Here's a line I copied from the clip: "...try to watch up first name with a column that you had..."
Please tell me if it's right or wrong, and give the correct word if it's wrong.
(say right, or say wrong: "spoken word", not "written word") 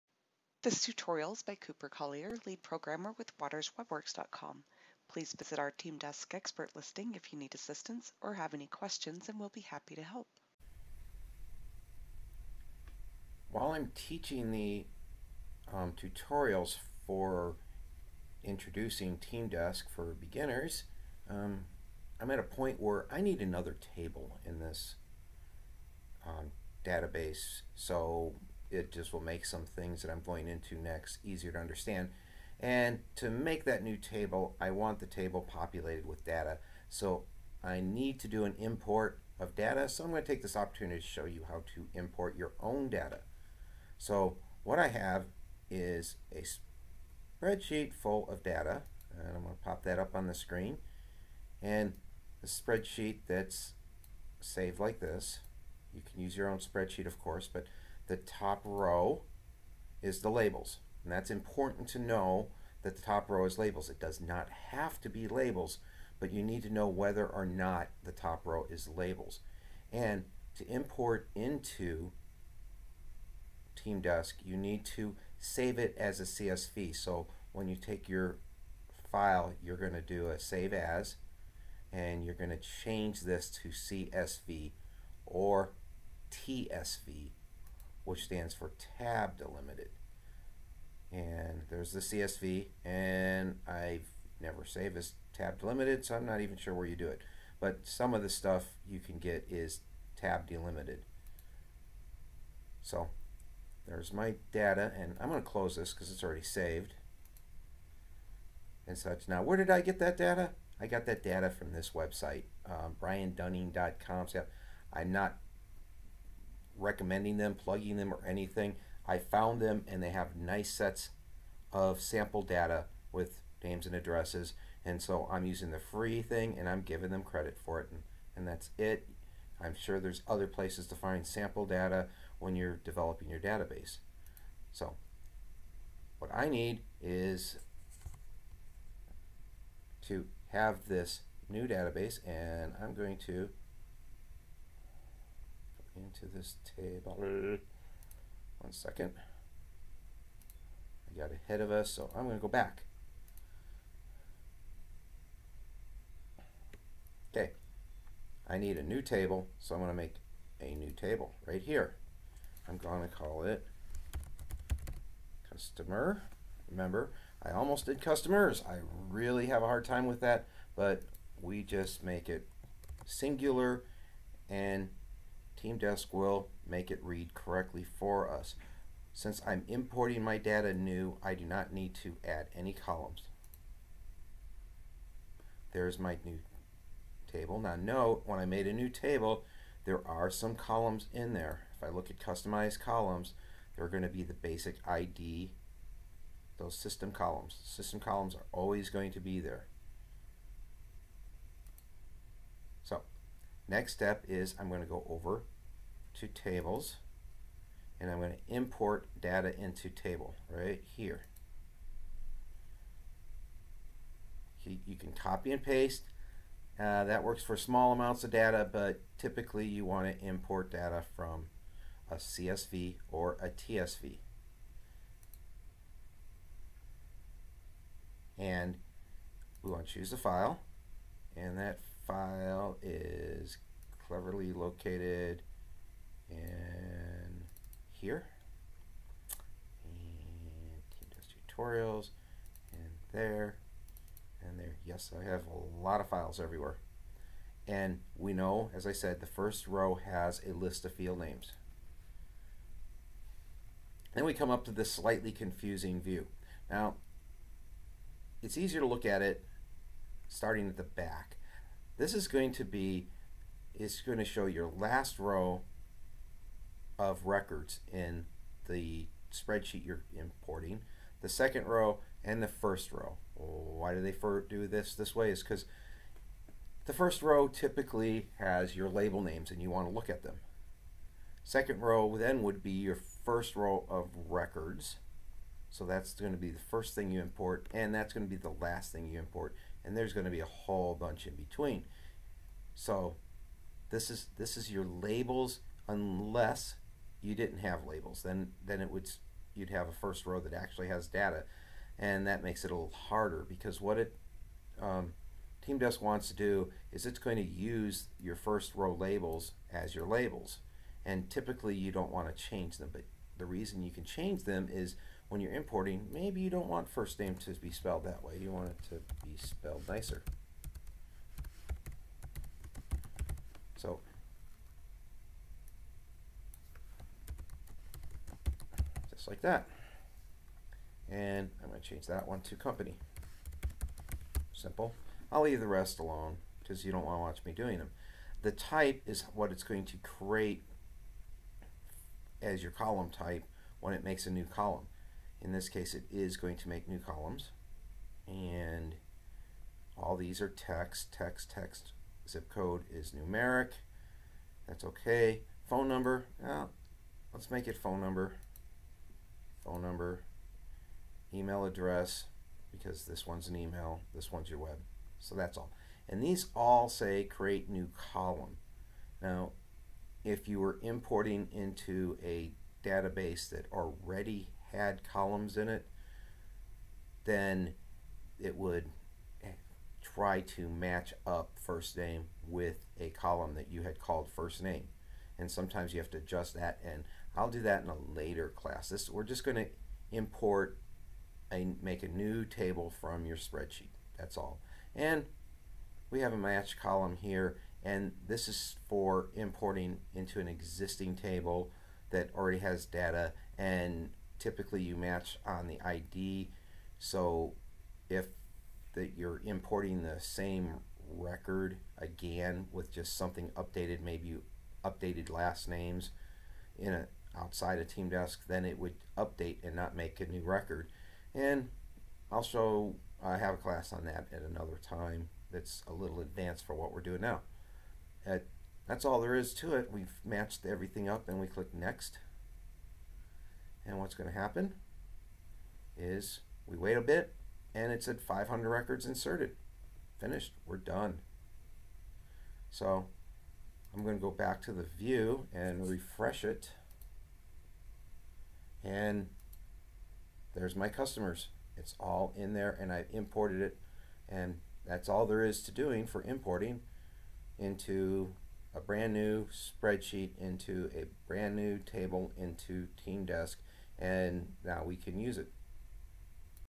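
wrong: "match", not "watch".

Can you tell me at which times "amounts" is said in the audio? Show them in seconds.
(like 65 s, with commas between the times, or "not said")
217 s.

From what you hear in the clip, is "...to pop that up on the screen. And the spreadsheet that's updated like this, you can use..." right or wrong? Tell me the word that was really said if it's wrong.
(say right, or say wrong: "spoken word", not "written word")
wrong: "saved", not "updated".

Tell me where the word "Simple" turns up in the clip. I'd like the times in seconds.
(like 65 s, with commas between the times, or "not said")
334 s.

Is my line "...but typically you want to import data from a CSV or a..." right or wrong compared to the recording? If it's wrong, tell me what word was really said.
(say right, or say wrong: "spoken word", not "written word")
right.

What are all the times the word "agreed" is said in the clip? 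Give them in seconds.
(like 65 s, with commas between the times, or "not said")
not said.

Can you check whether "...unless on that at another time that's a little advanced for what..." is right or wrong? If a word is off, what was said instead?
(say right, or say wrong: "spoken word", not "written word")
wrong: "class", not "unless".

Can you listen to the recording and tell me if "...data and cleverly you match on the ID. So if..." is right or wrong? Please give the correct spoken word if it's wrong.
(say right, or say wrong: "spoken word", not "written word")
wrong: "typically", not "cleverly".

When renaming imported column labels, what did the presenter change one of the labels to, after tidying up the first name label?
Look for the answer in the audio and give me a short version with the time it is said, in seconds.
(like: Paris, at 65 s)
company, at 332 s.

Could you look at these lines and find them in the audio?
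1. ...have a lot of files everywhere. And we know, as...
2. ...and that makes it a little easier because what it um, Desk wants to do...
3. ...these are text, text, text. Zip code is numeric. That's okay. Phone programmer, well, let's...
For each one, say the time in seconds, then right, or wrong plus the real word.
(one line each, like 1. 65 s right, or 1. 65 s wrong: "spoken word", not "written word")
1. 245 s right
2. 301 s wrong: "harder", not "easier"
3. 350 s wrong: "number", not "programmer".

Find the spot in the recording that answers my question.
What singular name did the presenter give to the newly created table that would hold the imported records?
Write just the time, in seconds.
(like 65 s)
165 s.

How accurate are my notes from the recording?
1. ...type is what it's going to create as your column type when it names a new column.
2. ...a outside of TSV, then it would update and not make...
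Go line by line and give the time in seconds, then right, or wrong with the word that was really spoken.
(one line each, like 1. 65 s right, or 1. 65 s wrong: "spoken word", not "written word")
1. 338 s wrong: "makes", not "names"
2. 416 s wrong: "TeamDesk", not "TSV".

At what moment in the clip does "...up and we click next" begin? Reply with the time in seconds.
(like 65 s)
431 s.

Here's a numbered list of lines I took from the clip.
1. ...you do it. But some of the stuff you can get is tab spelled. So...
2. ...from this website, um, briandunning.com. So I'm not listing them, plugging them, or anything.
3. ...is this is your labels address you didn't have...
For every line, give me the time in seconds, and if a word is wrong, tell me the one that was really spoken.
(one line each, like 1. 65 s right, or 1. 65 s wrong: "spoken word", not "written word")
1. 96 s wrong: "delimited", not "spelled"
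2. 111 s wrong: "recommending", not "listing"
3. 294 s wrong: "unless", not "address".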